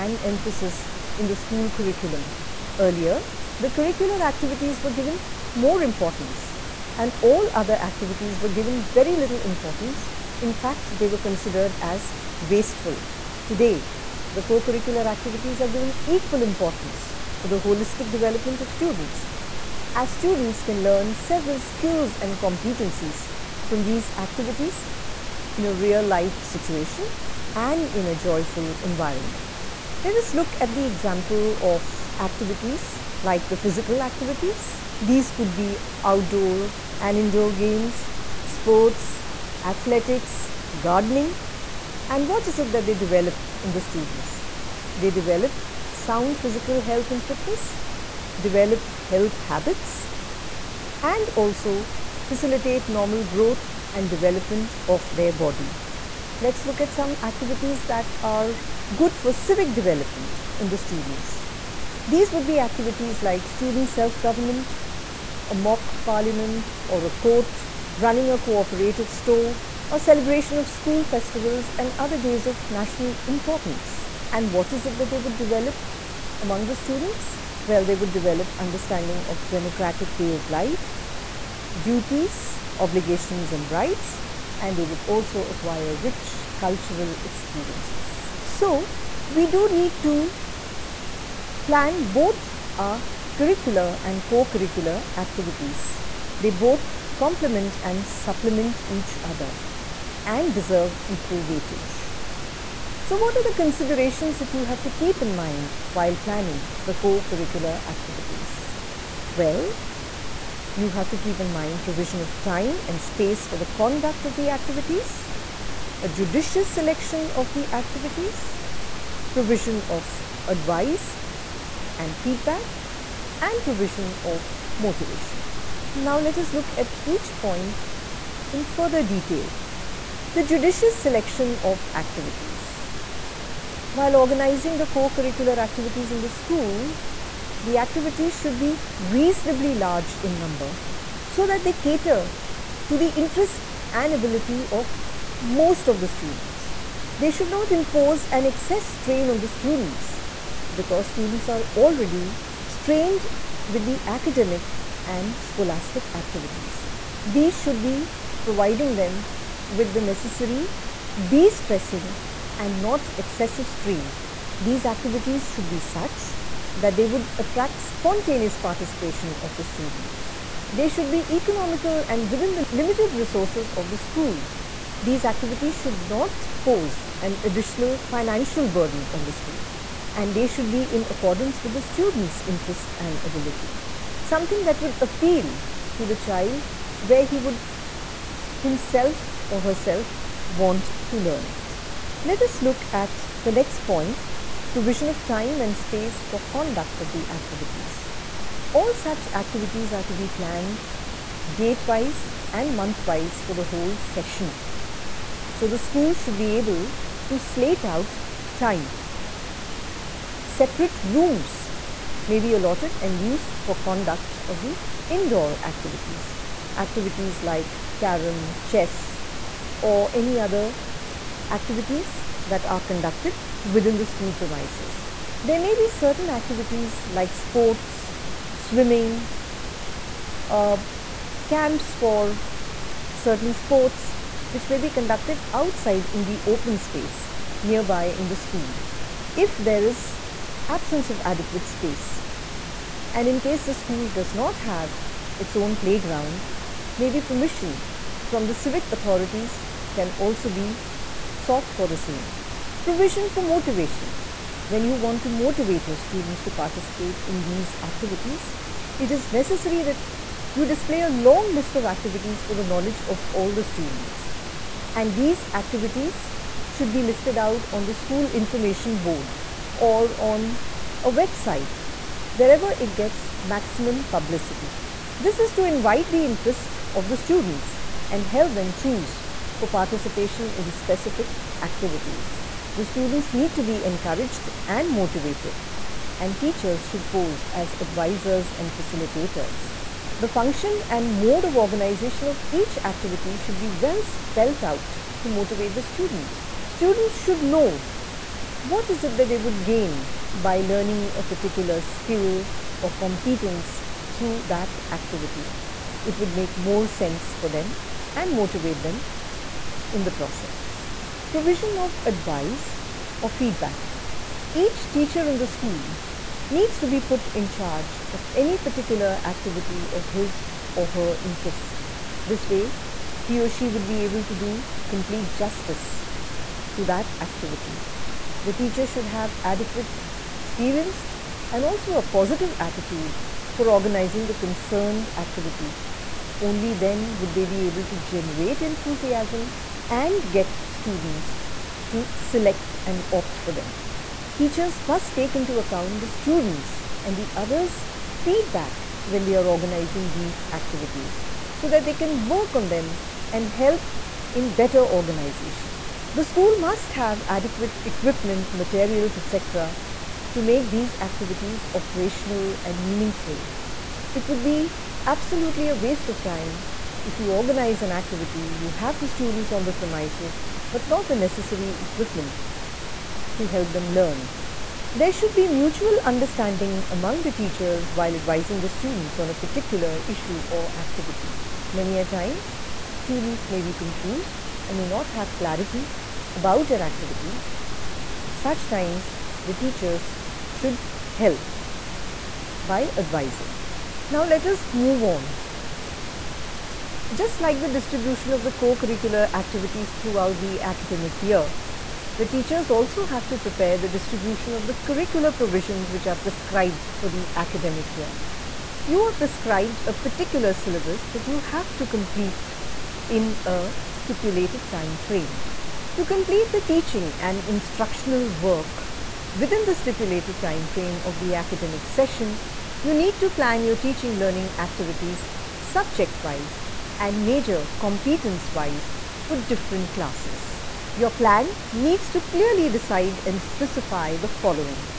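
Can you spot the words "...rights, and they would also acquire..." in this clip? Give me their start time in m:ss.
1:23.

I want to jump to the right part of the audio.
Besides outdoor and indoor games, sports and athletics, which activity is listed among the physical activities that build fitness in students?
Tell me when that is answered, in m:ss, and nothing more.
0:40.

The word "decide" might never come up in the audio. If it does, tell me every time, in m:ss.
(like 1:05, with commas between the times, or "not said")
7:12.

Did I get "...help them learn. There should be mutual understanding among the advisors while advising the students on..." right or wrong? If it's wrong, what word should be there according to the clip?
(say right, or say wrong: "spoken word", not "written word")
wrong: "teachers", not "advisors".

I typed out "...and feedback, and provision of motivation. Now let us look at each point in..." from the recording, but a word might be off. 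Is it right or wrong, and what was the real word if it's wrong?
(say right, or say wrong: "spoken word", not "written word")
right.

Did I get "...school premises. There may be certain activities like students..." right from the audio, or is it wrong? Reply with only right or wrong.
wrong.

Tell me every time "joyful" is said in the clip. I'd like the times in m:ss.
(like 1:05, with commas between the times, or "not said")
0:28.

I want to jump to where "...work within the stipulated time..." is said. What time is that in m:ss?
6:58.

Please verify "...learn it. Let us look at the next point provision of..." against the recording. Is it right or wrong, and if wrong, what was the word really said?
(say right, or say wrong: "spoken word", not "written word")
right.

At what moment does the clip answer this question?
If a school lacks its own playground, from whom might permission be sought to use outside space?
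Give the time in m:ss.
4:08.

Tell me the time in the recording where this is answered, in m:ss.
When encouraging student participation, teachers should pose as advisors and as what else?
4:48.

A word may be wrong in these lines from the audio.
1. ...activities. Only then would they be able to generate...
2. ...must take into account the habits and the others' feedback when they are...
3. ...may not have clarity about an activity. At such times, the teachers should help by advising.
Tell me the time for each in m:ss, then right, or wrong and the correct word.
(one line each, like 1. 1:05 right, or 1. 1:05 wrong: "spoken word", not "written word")
1. 5:35 right
2. 5:44 wrong: "students", not "habits"
3. 6:24 right.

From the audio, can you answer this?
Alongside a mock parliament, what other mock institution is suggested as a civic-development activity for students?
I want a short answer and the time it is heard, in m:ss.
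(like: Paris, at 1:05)
A court, at 1:07.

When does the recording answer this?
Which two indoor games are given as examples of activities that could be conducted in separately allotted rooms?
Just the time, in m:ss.
3:37.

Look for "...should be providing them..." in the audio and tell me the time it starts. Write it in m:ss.
2:37.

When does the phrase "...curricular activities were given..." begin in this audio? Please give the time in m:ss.
0:03.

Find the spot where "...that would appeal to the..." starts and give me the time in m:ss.
3:04.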